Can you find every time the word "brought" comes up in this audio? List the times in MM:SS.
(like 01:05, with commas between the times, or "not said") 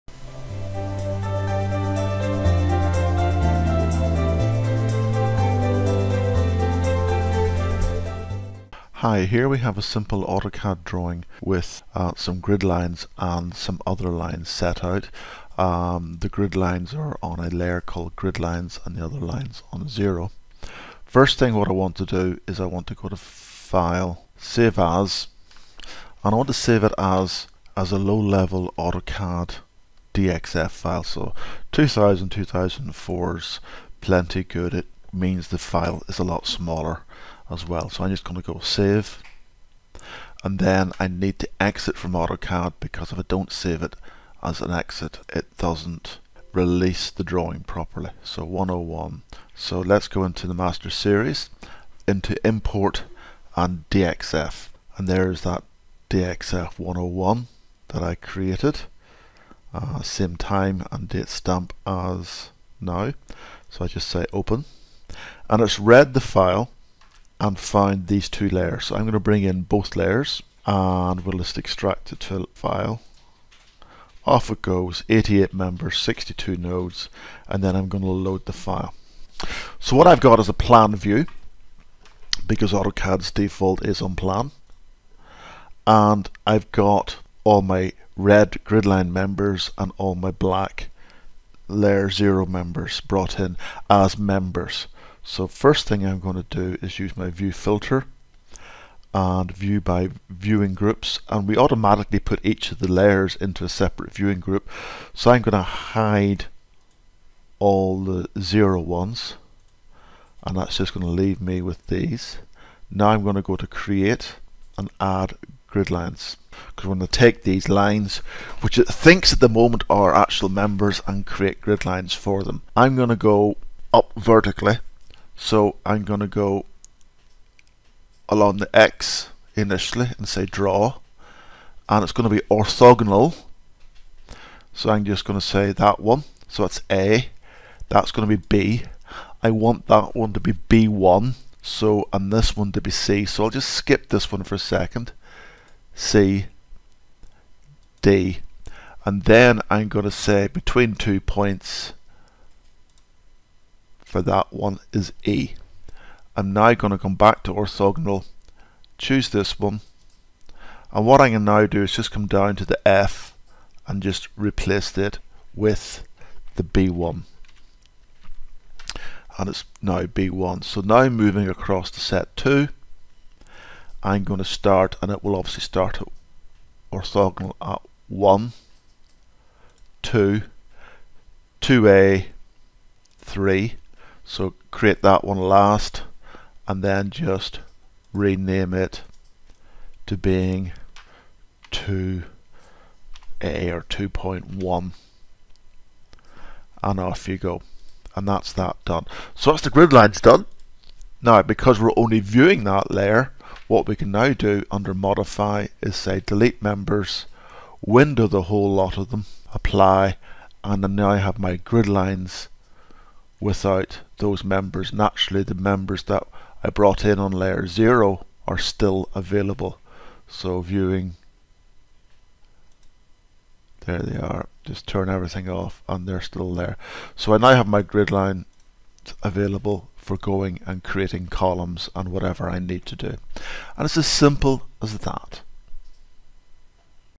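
01:33, 03:36.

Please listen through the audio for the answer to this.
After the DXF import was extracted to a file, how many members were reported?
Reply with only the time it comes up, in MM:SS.
01:15.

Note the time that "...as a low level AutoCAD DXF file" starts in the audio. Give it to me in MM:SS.
00:27.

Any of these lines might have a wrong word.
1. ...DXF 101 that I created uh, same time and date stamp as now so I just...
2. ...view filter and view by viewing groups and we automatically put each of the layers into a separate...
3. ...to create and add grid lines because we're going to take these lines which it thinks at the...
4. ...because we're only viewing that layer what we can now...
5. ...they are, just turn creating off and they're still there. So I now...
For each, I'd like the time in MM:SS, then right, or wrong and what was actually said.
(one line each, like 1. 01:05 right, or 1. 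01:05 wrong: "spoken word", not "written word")
1. 00:56 right
2. 01:37 right
3. 01:53 right
4. 03:21 right
5. 03:43 wrong: "everything", not "creating".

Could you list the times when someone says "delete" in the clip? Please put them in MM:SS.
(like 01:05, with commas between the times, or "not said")
03:26.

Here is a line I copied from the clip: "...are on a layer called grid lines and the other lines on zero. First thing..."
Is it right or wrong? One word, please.
right.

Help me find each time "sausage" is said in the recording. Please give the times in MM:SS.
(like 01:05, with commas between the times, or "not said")
not said.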